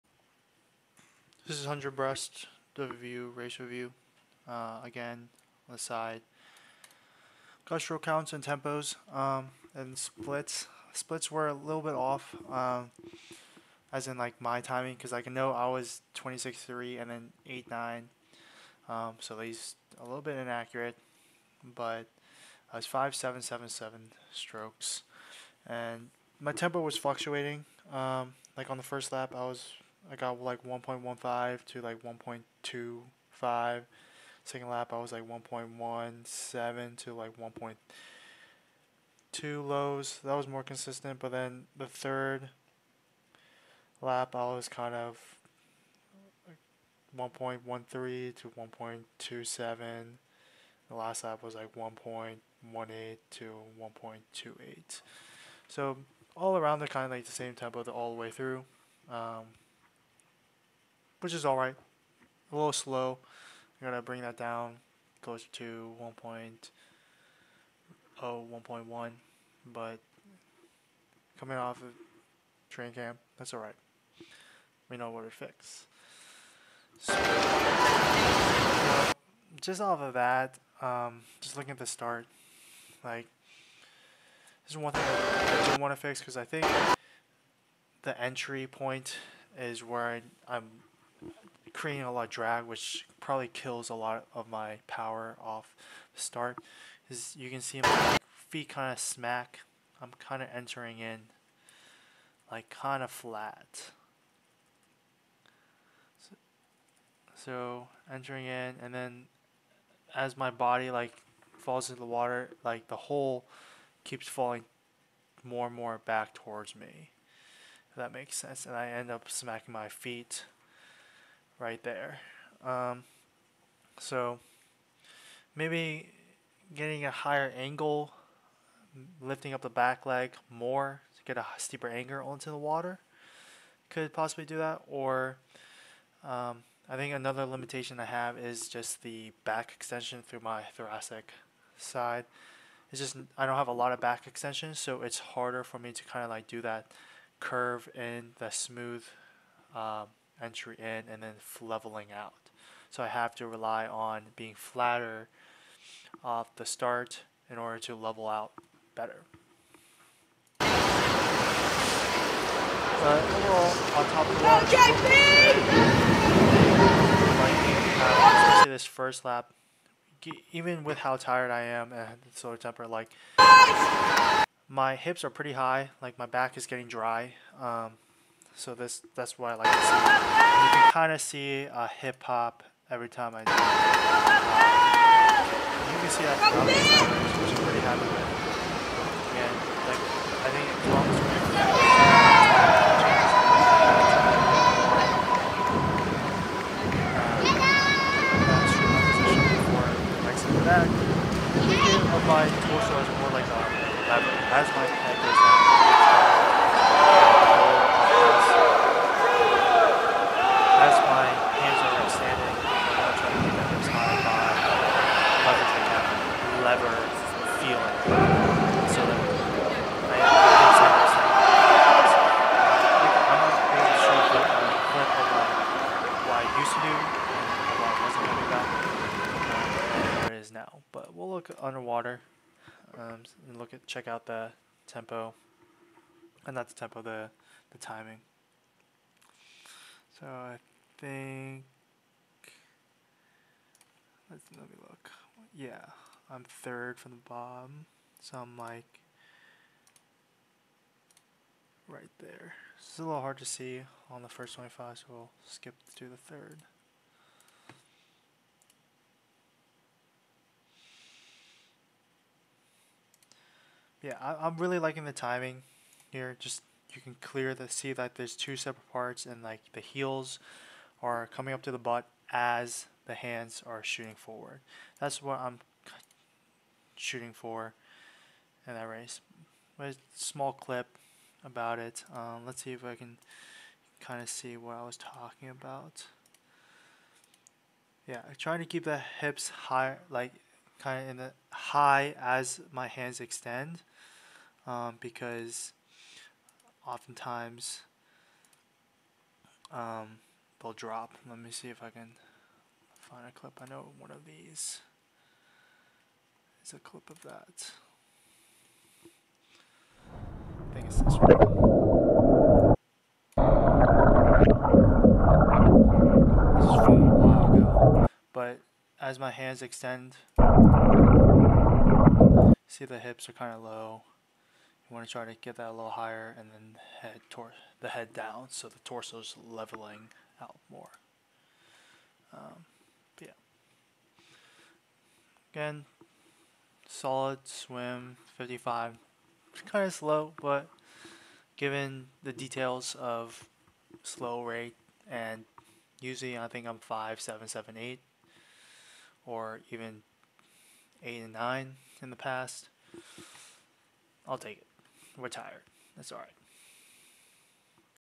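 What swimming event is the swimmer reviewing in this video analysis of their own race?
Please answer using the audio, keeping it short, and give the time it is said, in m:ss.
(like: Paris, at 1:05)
100 breast, at 0:01.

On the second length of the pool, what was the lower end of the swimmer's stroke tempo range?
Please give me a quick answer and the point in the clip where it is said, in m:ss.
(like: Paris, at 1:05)
1.17, at 0:35.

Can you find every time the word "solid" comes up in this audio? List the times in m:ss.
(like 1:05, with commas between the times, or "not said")
5:36.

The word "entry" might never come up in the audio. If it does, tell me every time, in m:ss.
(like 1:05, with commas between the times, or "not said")
1:28, 2:30.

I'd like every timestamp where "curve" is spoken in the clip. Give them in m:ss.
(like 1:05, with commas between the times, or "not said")
2:27.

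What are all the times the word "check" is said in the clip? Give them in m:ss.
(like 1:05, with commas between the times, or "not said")
3:53.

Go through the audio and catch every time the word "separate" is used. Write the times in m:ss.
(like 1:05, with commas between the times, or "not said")
4:28.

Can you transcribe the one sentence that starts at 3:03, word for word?
Uh, you can see that throughout the covers, which I'm pretty happy with.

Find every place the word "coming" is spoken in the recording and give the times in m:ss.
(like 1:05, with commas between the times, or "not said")
1:11, 4:31.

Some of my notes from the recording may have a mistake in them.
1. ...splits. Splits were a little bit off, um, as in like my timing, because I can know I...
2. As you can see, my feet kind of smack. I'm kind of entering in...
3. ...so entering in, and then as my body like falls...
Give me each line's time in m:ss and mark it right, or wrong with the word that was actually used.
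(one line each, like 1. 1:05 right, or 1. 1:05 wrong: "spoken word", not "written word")
1. 0:09 right
2. 1:37 right
3. 1:47 right.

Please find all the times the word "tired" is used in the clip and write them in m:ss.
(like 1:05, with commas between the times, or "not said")
2:51, 5:55.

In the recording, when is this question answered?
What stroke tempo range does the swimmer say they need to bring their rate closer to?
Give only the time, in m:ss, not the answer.
1:06.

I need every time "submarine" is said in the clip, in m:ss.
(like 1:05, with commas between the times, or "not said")
not said.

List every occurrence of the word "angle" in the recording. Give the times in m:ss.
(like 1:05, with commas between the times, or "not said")
2:07, 2:11.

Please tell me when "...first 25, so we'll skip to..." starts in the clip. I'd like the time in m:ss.
4:14.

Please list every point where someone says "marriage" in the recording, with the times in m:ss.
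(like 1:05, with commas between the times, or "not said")
not said.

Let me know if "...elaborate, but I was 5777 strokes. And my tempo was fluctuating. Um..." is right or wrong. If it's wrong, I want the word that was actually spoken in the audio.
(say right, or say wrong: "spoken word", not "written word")
wrong: "inaccurate", not "elaborate".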